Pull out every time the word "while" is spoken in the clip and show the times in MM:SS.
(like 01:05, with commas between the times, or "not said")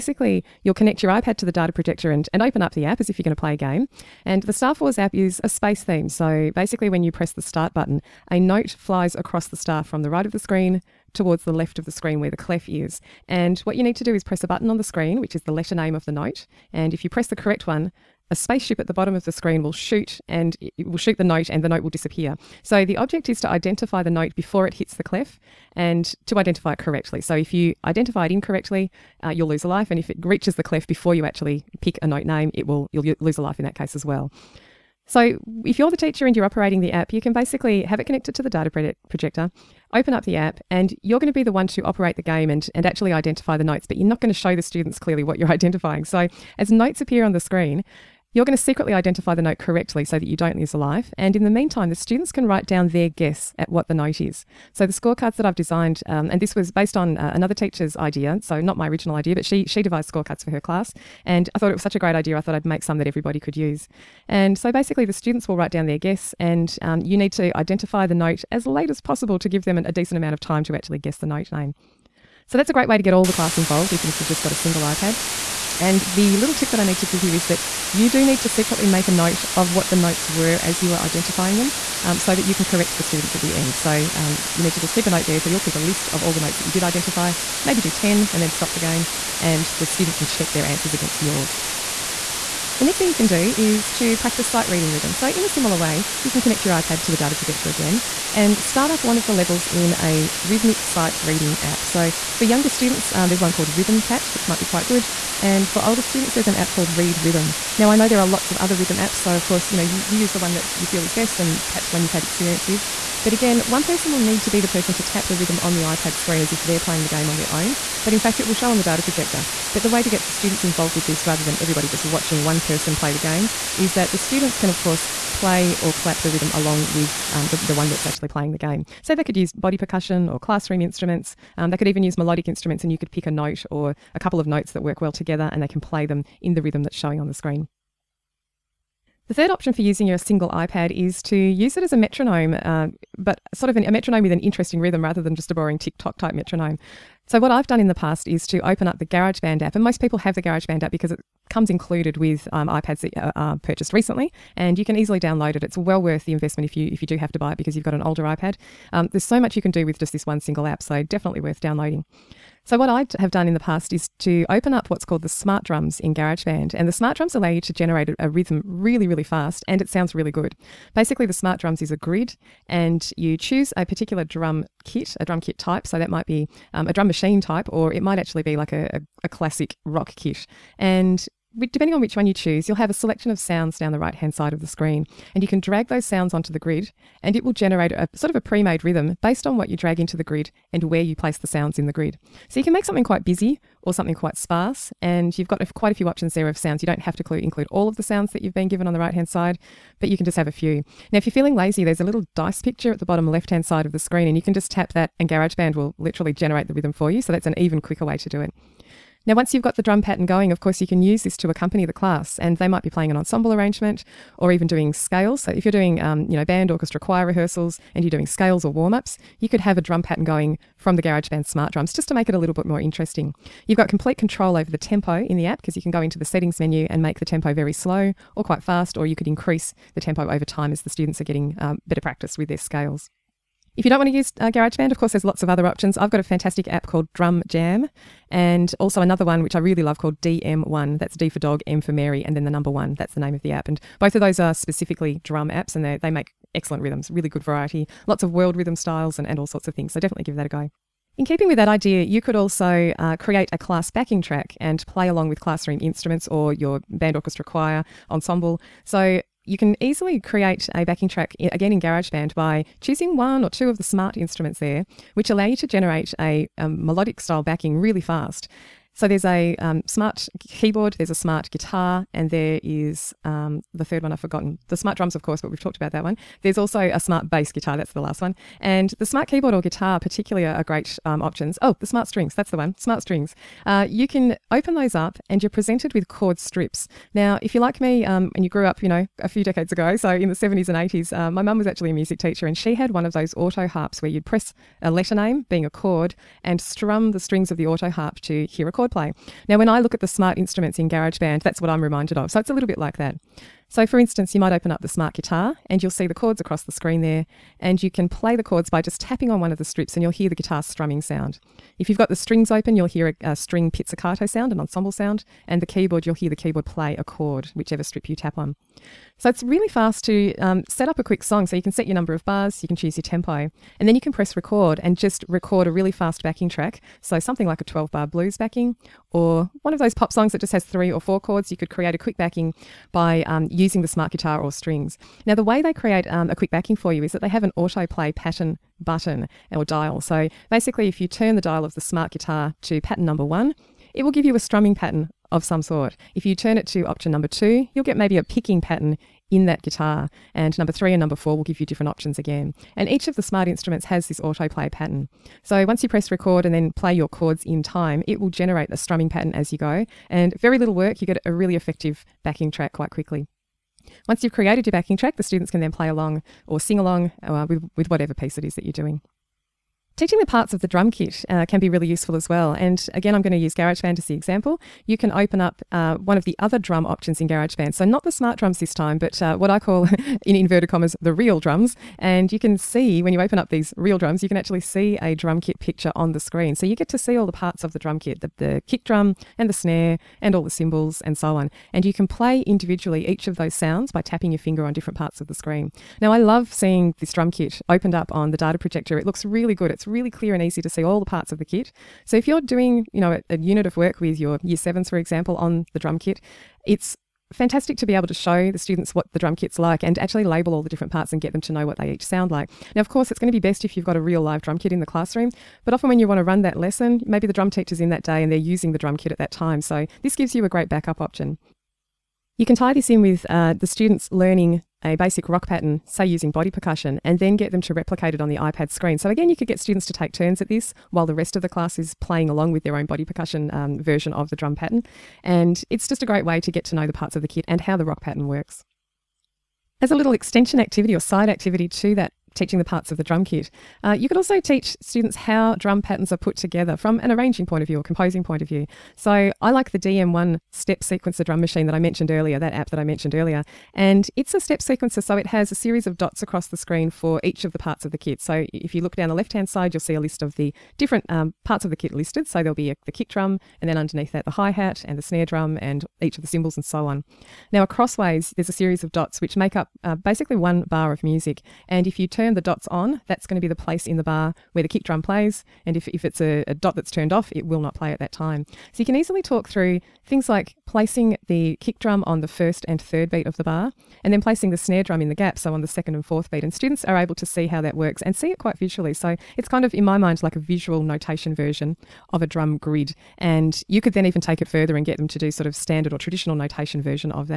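07:10.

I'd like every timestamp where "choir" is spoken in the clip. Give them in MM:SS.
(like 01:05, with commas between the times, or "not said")
03:36, 04:17.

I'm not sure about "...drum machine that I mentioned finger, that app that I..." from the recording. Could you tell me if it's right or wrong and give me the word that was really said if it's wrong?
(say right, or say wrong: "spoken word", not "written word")
wrong: "earlier", not "finger".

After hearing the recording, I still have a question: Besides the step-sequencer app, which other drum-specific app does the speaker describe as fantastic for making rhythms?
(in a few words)
Drum Jam.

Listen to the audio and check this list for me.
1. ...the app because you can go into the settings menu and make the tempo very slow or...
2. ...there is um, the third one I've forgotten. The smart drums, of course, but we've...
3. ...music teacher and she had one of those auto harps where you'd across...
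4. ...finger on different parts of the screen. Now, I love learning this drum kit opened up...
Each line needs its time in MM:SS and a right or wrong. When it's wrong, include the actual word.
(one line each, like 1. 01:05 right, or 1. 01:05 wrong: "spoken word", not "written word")
1. 03:45 right
2. 04:32 right
3. 04:51 wrong: "press", not "across"
4. 06:34 wrong: "seeing", not "learning".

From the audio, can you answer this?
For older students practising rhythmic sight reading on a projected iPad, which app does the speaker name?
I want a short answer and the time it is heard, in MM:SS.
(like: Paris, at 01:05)
Read Rhythm, at 01:46.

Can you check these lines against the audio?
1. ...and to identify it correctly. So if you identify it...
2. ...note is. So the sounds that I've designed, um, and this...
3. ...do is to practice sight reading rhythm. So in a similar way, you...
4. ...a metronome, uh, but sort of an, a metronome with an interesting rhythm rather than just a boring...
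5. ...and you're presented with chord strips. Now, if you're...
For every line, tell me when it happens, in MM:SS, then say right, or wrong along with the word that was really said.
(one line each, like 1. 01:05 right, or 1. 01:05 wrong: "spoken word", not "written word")
1. 00:25 right
2. 00:53 wrong: "scorecards", not "sounds"
3. 01:33 right
4. 02:21 right
5. 04:45 right.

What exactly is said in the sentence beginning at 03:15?
And you've got a, quite a few options there of sounds.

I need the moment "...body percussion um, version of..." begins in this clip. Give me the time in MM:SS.
07:12.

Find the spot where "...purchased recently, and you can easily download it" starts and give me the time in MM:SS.
02:33.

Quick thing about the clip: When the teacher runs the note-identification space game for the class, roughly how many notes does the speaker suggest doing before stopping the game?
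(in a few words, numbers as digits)
10.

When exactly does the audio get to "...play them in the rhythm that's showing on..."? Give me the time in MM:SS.
02:15.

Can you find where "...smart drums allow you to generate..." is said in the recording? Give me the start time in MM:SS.
02:46.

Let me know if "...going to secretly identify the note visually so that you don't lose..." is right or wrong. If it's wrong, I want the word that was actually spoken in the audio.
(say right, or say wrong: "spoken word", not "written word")
wrong: "correctly", not "visually".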